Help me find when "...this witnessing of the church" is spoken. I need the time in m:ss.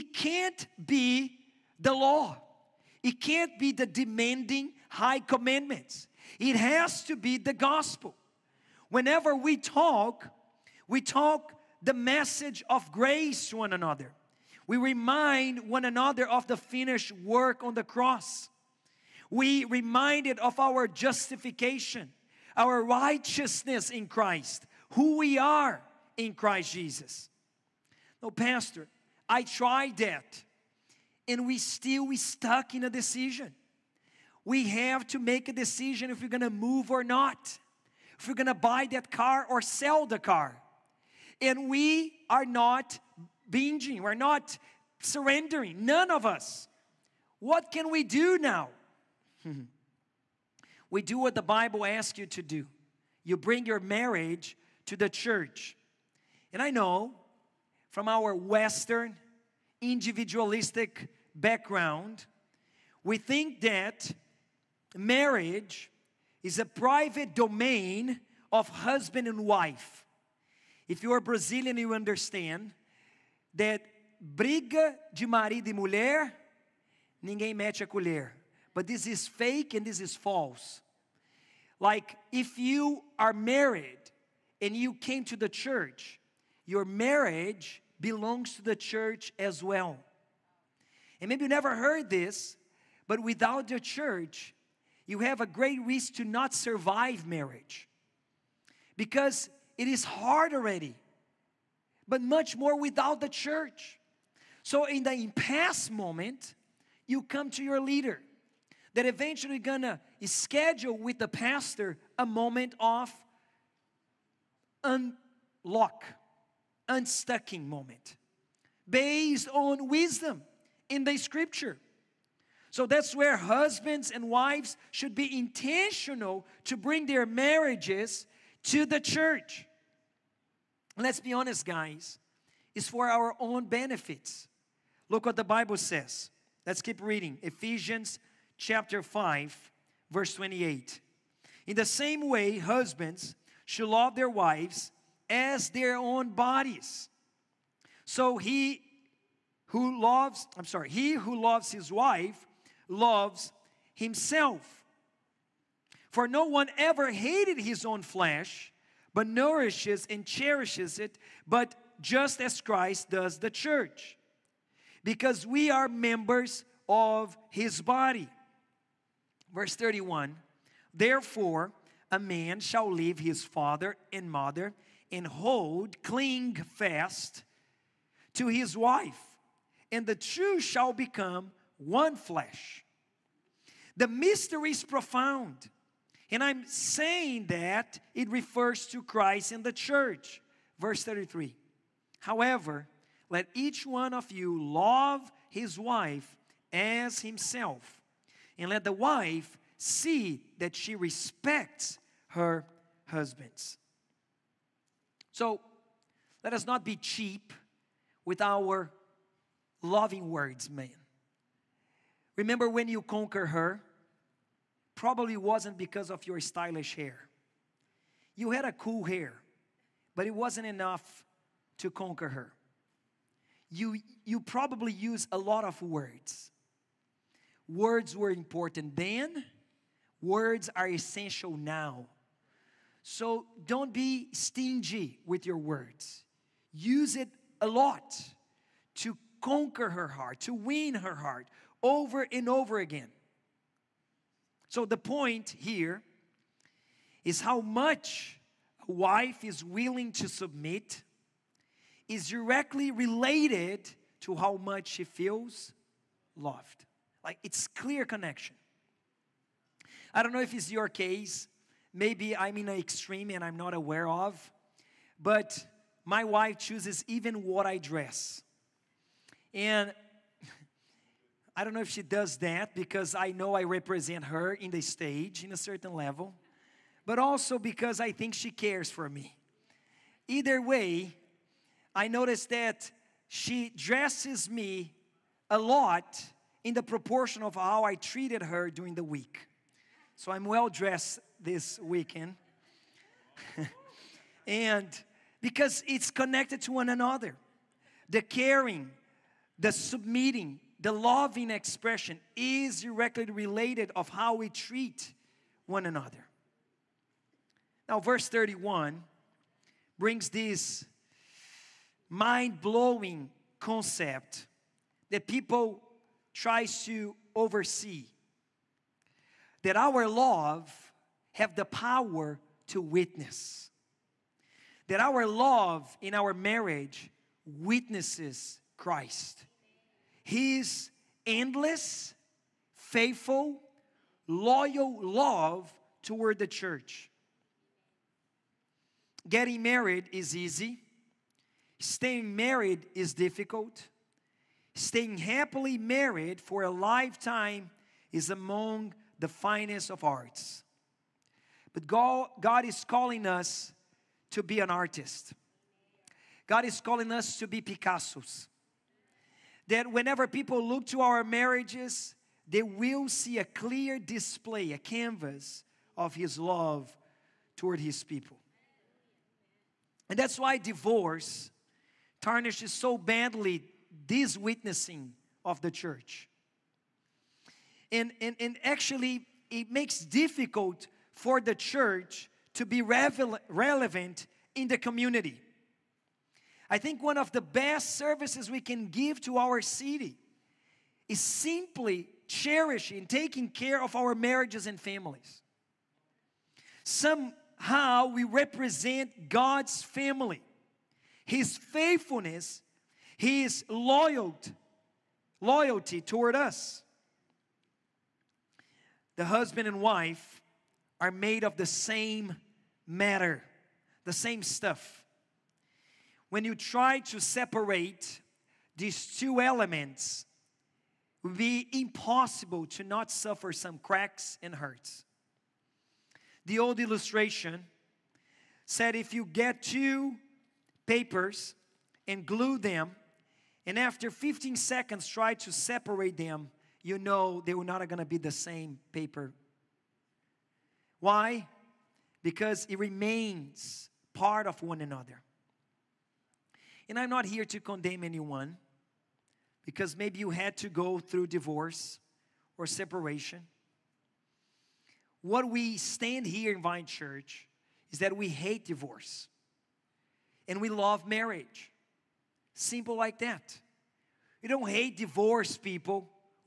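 6:14.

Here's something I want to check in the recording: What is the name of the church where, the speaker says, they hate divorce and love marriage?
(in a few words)
Vine Church.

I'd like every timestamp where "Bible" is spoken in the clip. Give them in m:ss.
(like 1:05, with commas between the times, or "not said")
0:51, 2:15.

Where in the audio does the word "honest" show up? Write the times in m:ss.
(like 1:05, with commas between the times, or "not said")
2:11.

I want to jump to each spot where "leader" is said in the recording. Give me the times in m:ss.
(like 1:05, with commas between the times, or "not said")
1:47.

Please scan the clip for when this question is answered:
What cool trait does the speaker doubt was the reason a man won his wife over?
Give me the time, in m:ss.
3:36.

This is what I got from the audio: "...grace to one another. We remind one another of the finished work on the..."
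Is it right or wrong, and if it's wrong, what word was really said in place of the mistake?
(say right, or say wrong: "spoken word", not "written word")
right.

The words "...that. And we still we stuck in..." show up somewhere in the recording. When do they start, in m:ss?
0:29.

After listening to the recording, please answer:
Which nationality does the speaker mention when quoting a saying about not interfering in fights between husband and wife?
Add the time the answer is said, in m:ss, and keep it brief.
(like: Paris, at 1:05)
Brazilian, at 1:11.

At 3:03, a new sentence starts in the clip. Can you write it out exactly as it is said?
The mystery is profound, and I'm saying that it refers to Christ and the church.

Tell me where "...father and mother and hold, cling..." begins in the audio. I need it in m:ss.
2:53.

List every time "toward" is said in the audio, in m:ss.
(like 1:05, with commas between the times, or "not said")
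5:36, 6:07, 6:46.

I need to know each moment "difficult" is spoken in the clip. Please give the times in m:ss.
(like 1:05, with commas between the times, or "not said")
5:43, 6:19.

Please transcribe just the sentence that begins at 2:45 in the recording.
Because we are members of his body.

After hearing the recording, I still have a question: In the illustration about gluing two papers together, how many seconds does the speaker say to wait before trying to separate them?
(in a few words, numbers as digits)
15.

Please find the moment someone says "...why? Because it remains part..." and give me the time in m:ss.
7:21.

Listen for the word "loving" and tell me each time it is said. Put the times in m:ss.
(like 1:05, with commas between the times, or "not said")
3:29, 5:00.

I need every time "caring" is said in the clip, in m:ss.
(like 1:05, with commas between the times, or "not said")
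4:58.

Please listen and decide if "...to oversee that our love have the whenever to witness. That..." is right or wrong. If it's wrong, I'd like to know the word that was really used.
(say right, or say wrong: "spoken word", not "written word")
wrong: "power", not "whenever".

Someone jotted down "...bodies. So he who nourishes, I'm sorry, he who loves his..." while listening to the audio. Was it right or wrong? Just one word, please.
wrong.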